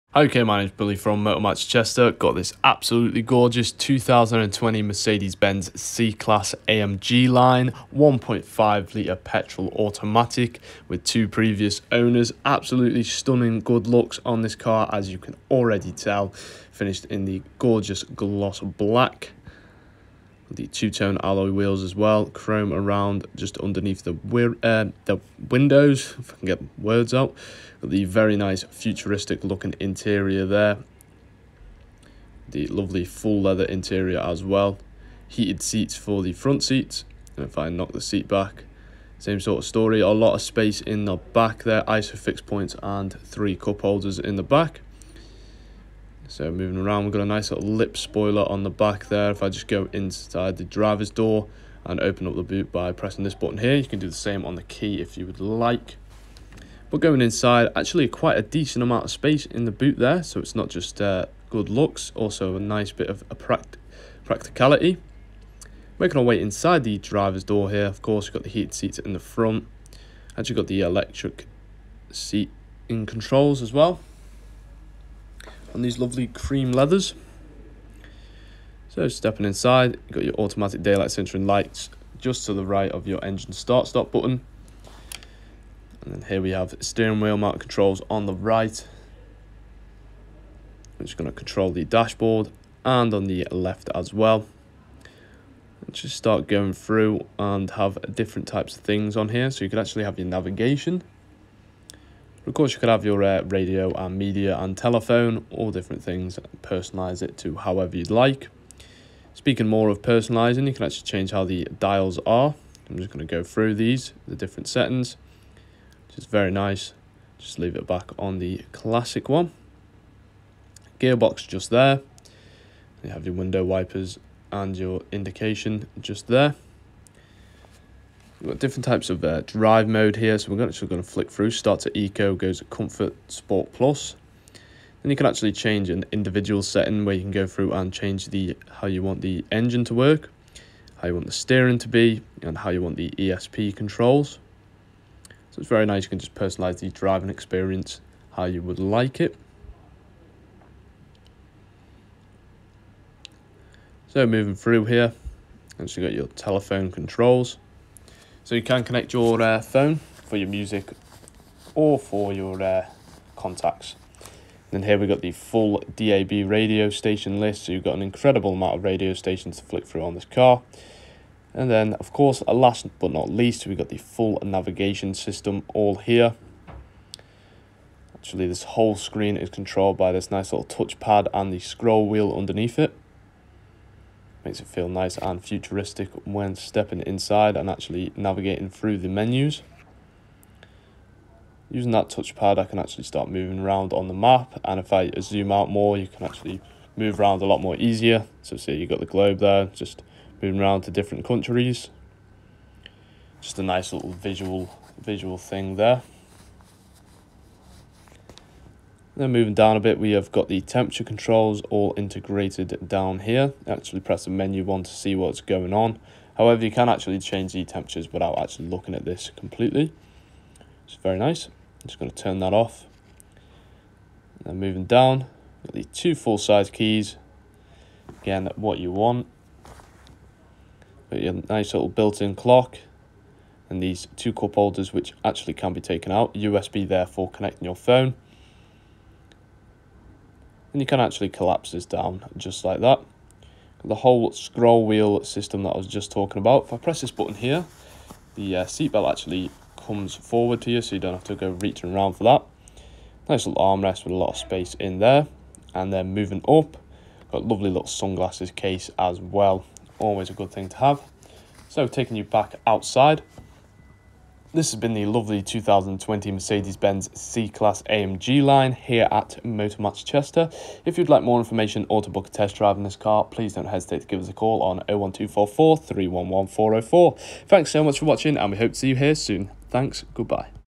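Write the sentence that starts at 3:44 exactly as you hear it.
And moving down, got the two full size keys.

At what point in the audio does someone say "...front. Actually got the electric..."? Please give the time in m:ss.
1:09.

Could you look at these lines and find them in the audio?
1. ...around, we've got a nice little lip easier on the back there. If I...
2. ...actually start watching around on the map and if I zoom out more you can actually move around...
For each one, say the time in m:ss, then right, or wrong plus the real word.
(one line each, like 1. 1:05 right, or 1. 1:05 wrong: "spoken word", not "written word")
1. 0:46 wrong: "spoiler", not "easier"
2. 3:12 wrong: "moving", not "watching".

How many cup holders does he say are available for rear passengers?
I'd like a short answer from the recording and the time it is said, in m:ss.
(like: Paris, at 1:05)
3, at 0:43.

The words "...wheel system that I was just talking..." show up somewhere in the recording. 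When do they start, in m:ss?
4:04.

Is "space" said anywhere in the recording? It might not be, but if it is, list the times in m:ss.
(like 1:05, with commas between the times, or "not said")
0:40, 0:59, 4:14.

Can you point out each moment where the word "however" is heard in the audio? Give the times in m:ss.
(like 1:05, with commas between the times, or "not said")
1:47, 3:36.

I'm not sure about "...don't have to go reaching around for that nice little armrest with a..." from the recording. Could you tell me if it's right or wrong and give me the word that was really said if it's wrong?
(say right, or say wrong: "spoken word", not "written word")
right.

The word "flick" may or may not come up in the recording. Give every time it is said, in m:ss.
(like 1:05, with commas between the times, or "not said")
2:11, 2:49.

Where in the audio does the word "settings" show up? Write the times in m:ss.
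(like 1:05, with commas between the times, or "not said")
1:54, 2:16.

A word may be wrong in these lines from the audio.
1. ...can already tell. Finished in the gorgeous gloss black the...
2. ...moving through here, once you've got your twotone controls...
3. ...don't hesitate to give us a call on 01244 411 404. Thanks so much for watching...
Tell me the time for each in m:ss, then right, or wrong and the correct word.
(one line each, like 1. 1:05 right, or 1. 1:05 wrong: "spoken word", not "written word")
1. 0:15 right
2. 2:34 wrong: "telephone", not "twotone"
3. 4:33 wrong: "311", not "411".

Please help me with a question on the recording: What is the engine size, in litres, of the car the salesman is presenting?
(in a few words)
1.5 litre.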